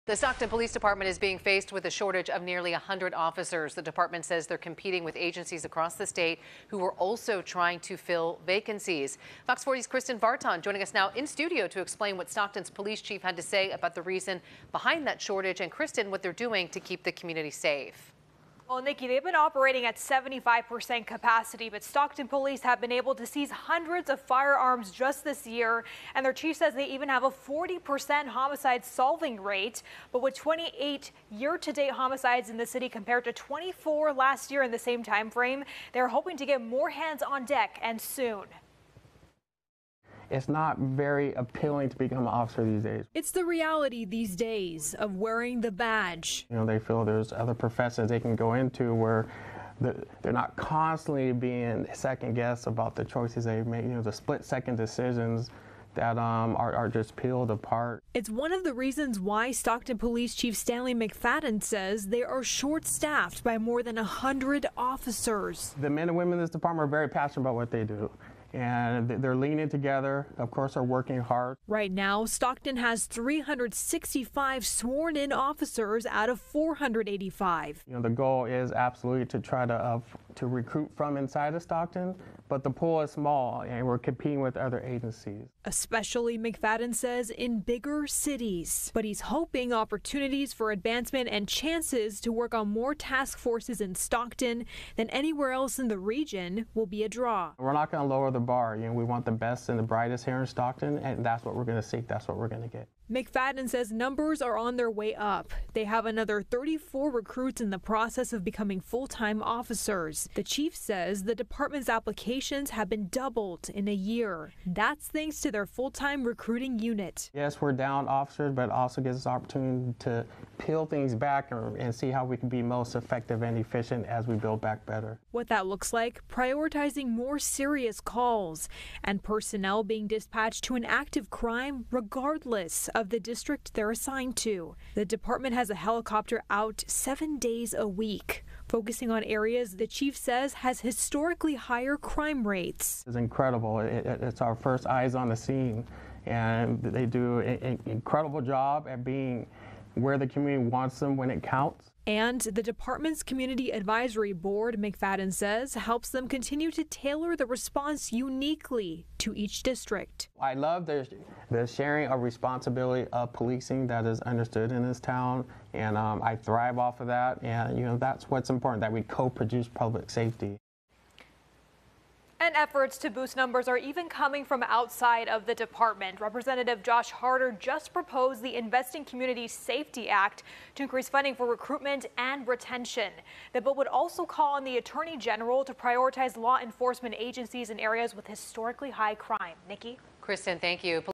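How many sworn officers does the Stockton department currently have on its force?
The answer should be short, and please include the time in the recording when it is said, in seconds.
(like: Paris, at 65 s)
365, at 73 s.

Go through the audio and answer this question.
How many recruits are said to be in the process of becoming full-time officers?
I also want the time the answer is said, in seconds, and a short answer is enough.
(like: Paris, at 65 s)
34, at 106 s.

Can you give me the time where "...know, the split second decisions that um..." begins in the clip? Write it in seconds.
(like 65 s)
53 s.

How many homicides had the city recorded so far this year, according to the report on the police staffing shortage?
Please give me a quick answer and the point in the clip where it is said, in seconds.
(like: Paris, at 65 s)
28, at 30 s.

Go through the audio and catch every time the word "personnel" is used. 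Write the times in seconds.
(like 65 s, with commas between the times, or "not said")
129 s.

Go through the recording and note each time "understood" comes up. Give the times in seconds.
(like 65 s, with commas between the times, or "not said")
164 s.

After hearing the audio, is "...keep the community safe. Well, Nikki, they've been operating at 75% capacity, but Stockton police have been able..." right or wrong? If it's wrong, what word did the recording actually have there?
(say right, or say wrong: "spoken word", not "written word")
right.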